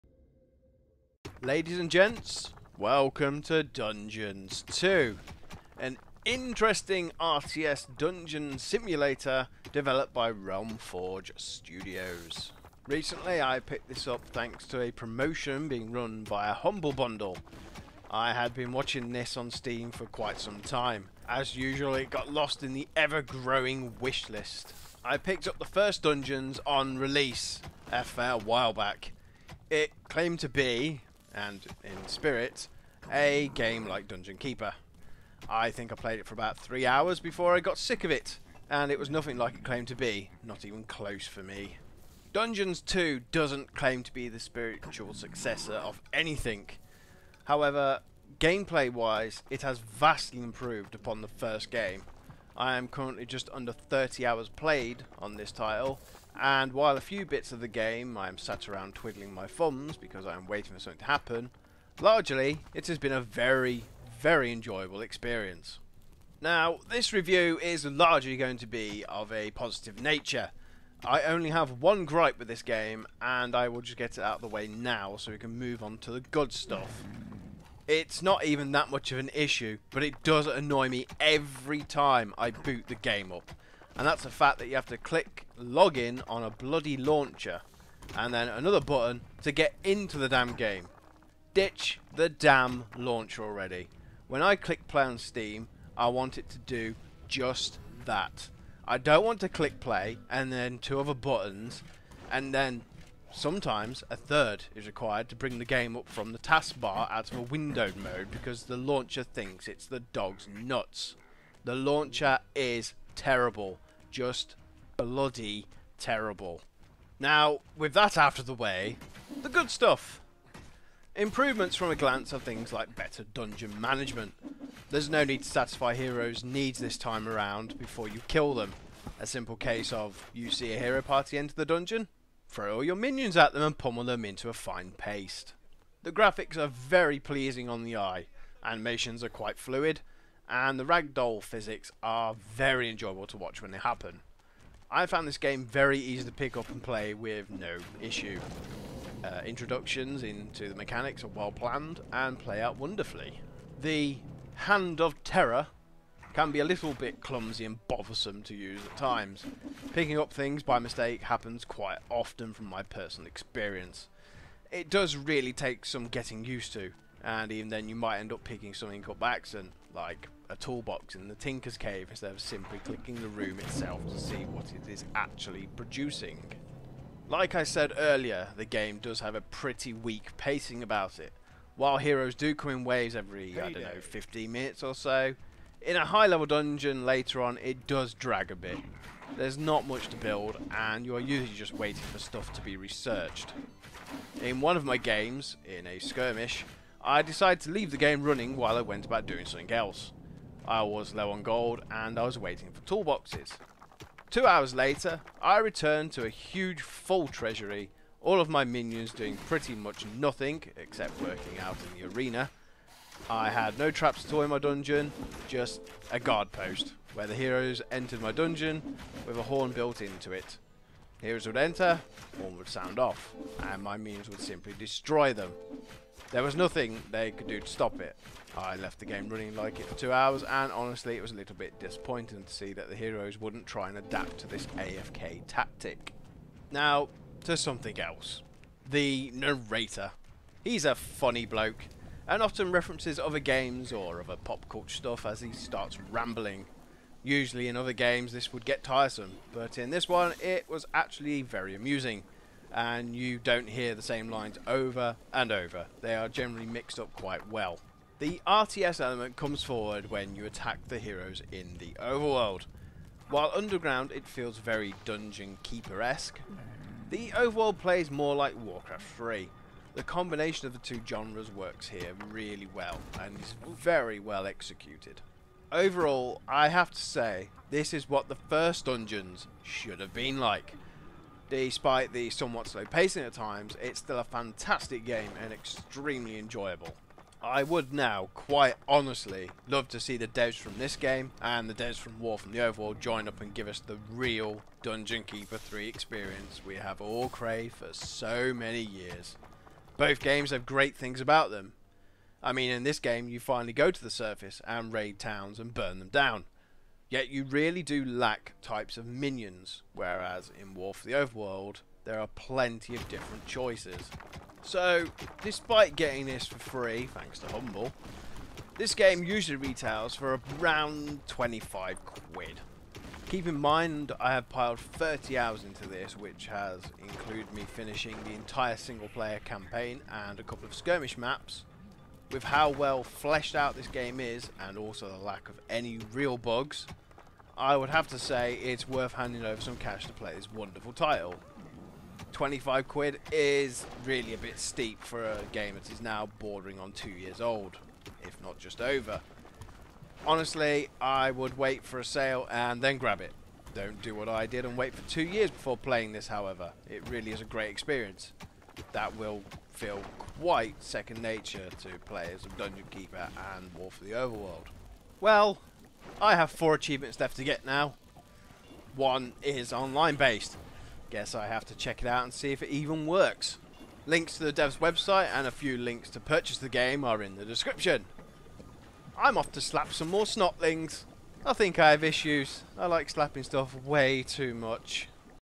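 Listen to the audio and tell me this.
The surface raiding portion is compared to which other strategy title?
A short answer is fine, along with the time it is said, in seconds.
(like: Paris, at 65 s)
Warcraft 3, at 268 s.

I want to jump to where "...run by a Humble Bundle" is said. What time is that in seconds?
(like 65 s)
15 s.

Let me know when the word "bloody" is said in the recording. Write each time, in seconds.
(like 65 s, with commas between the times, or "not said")
86 s, 114 s.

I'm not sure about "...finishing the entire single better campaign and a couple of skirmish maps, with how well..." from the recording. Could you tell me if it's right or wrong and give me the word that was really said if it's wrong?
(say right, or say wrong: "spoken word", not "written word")
wrong: "player", not "better".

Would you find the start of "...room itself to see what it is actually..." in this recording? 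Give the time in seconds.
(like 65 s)
173 s.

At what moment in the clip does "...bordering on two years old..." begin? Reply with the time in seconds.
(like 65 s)
346 s.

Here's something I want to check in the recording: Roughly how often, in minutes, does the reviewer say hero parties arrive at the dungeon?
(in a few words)
15 minutes.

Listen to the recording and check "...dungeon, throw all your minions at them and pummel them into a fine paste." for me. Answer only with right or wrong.
right.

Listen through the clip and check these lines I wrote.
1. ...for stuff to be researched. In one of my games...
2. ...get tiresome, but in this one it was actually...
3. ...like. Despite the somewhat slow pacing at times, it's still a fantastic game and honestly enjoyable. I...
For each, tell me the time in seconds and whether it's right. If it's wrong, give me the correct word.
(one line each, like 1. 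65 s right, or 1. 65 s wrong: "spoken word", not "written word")
1. 192 s right
2. 248 s right
3. 280 s wrong: "extremely", not "honestly".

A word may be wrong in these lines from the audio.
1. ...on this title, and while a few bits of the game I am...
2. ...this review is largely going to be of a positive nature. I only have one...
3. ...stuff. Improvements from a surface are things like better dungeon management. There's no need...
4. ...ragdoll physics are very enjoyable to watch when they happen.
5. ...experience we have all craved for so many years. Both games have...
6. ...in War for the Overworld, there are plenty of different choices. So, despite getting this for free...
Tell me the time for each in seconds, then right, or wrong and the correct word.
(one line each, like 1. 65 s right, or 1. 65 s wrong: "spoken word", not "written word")
1. 55 s right
2. 66 s right
3. 119 s wrong: "glance", not "surface"
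4. 140 s right
5. 295 s right
6. 310 s right.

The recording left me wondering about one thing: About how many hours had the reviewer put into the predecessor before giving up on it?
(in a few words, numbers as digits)
3 hours.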